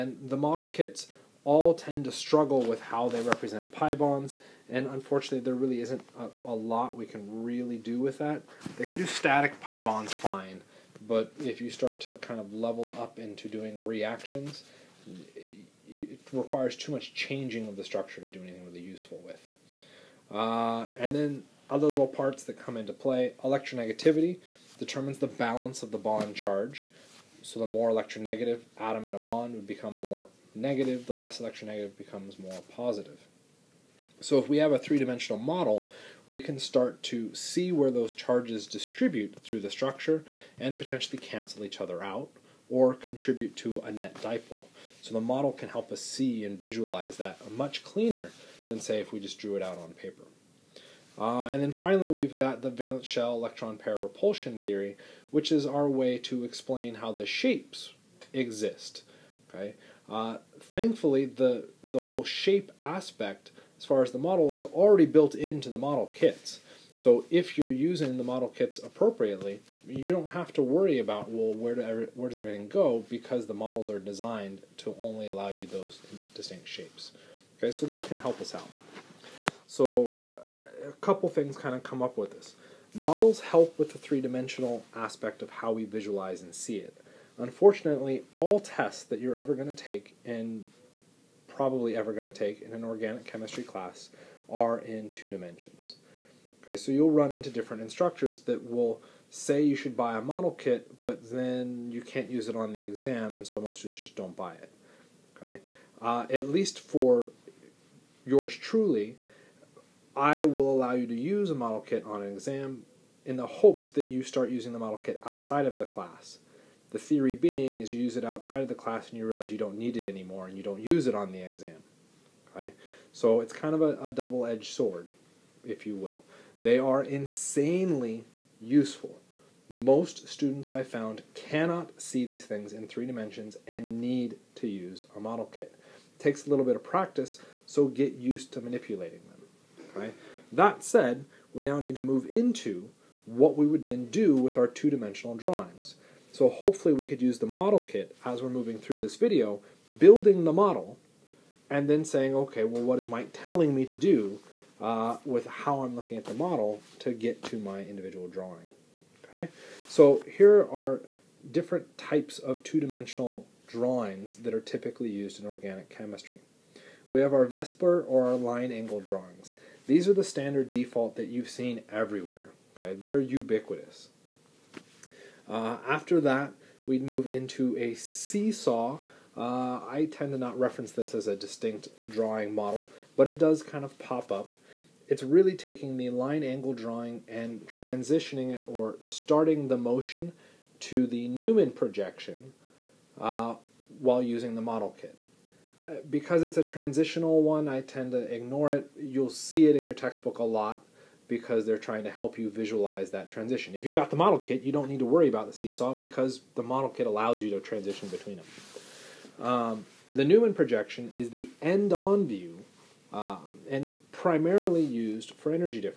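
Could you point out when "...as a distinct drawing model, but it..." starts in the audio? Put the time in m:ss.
3:01.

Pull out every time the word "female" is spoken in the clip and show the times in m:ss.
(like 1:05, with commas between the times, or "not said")
not said.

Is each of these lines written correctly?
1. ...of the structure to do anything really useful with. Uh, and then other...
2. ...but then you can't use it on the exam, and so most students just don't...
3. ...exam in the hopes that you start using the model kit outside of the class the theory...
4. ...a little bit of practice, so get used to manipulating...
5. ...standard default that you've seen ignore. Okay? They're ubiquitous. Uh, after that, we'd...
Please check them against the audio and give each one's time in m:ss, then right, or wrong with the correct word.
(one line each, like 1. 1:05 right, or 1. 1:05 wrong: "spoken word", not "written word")
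1. 0:17 right
2. 1:41 right
3. 1:52 right
4. 2:16 right
5. 2:50 wrong: "everywhere", not "ignore".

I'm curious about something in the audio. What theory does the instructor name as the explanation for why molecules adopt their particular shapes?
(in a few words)
Valence shell electron pair repulsion theory.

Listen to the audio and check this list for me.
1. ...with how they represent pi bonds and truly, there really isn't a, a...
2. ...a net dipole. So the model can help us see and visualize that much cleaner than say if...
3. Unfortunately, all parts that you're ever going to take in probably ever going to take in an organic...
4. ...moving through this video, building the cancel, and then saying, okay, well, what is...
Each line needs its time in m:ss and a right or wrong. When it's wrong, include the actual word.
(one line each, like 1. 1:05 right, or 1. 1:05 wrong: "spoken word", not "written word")
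1. 0:02 wrong: "unfortunately", not "truly"
2. 0:43 right
3. 1:27 wrong: "tests", not "parts"
4. 2:28 wrong: "model", not "cancel".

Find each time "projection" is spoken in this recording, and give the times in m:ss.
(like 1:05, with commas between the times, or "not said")
3:11, 3:30.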